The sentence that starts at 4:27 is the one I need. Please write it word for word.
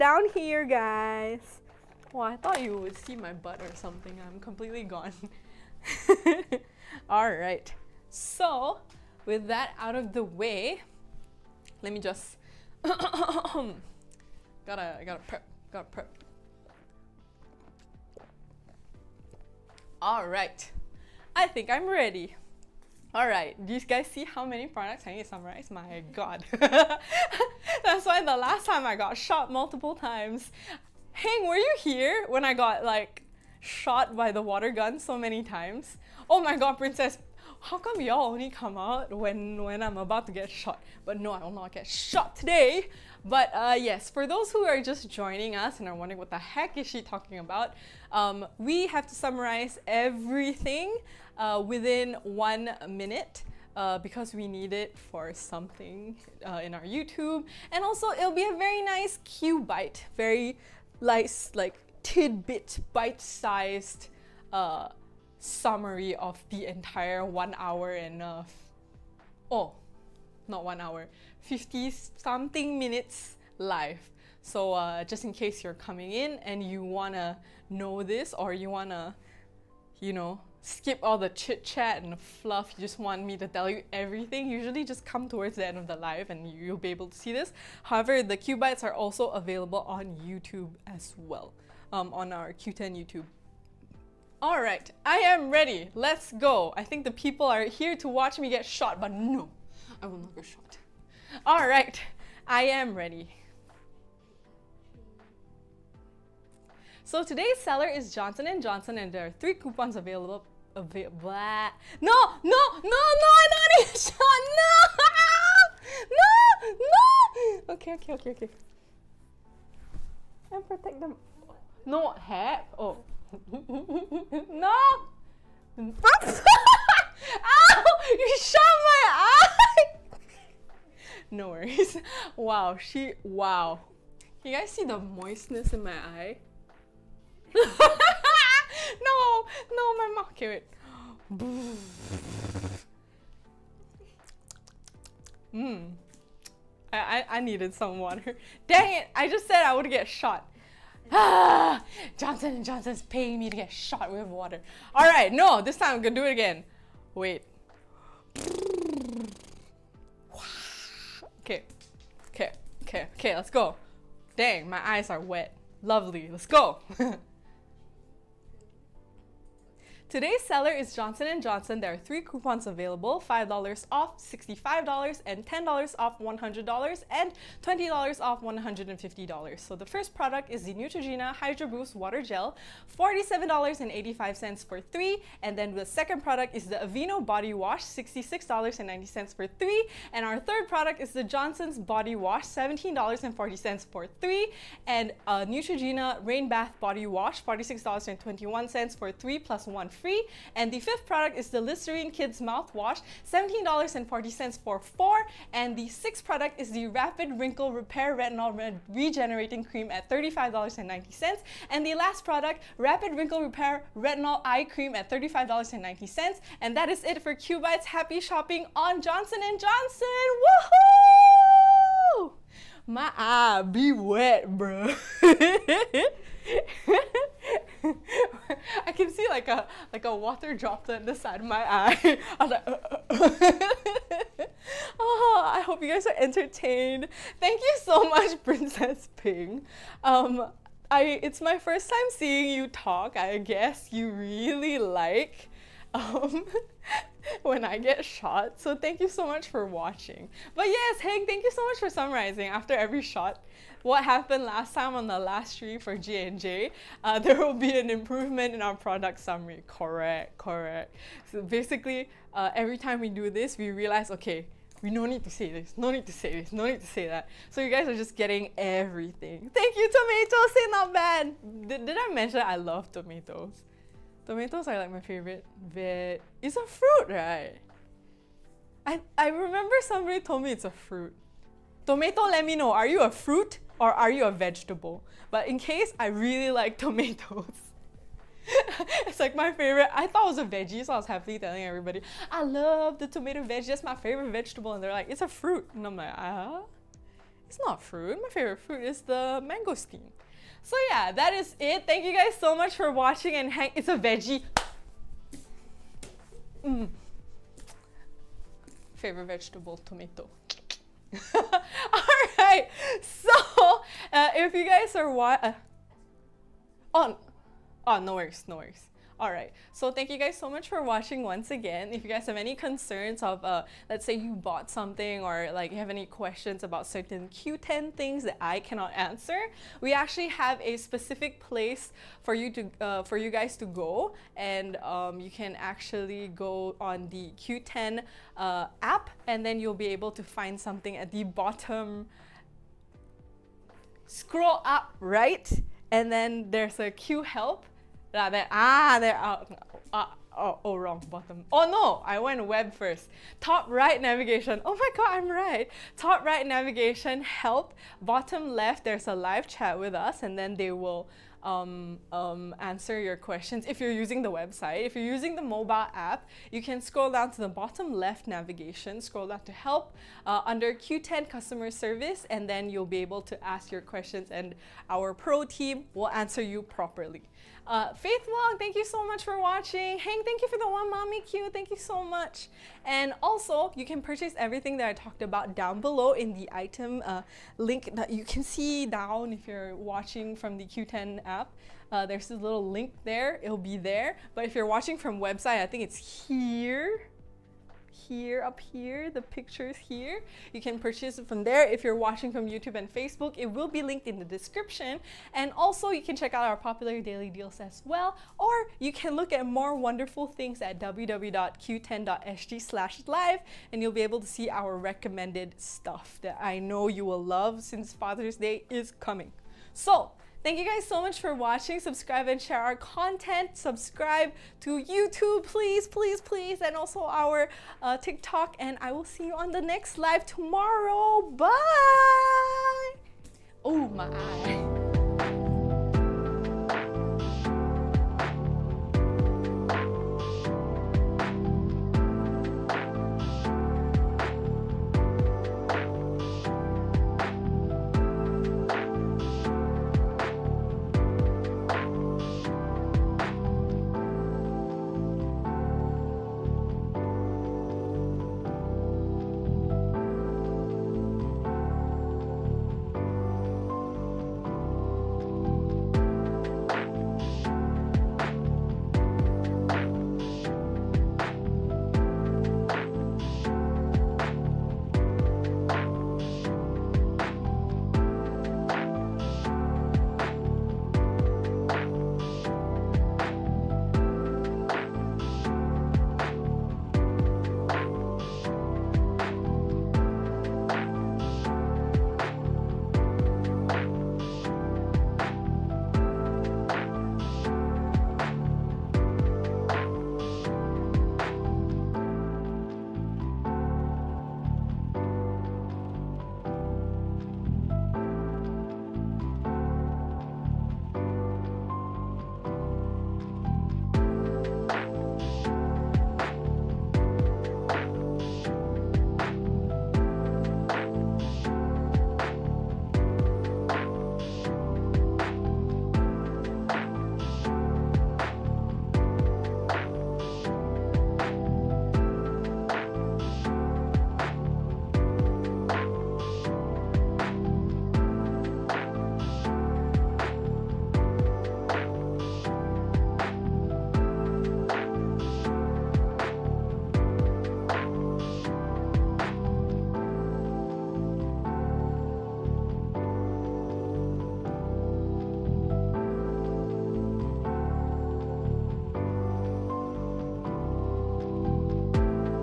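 So you guys are just getting everything.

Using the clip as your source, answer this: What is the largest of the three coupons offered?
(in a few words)
$20 off $150.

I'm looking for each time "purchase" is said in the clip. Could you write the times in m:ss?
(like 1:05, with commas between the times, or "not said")
6:23, 6:40.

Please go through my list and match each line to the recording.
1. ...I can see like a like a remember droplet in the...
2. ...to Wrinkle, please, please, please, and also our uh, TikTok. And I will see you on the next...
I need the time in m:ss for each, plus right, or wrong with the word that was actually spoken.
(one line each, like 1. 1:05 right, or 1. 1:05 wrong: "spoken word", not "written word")
1. 3:48 wrong: "water", not "remember"
2. 7:04 wrong: "YouTube", not "Wrinkle".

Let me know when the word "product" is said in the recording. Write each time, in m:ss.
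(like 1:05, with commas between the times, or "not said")
0:24, 3:00, 3:06, 3:10, 3:21, 3:26, 3:32, 4:18.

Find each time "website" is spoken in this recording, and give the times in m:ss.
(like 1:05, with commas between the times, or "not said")
6:04, 6:35.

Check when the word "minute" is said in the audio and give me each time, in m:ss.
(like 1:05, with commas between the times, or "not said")
0:52, 1:12.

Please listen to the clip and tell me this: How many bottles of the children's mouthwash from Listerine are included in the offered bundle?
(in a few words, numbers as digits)
4.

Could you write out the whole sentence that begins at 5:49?
Ah, uh, uh, oh, oh, wrong bottom.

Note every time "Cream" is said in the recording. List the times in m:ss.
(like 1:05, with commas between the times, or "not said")
3:29, 3:34.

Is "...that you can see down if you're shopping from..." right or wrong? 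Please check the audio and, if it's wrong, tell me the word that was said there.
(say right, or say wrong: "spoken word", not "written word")
wrong: "watching", not "shopping".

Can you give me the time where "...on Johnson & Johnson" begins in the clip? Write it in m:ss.
3:38.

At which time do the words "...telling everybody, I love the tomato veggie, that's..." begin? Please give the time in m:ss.
4:51.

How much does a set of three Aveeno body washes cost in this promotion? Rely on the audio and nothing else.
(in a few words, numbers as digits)
$66.90.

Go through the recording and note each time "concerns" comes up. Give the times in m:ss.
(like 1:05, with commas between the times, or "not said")
5:22.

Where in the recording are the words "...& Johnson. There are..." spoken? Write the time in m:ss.
2:51.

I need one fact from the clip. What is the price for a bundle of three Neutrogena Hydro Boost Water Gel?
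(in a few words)
$47.85.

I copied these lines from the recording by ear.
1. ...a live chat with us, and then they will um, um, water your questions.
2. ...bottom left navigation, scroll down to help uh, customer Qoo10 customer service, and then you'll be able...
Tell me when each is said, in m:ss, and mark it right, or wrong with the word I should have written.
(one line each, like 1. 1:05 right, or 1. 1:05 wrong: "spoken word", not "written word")
1. 5:59 wrong: "answer", not "water"
2. 6:07 wrong: "under", not "customer".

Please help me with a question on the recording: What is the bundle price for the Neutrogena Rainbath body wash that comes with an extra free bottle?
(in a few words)
$46.21.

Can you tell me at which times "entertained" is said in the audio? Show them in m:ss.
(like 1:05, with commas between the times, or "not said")
3:56.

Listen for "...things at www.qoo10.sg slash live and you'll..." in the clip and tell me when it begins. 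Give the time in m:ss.
6:50.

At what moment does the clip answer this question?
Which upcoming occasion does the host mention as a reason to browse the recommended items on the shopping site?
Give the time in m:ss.
6:57.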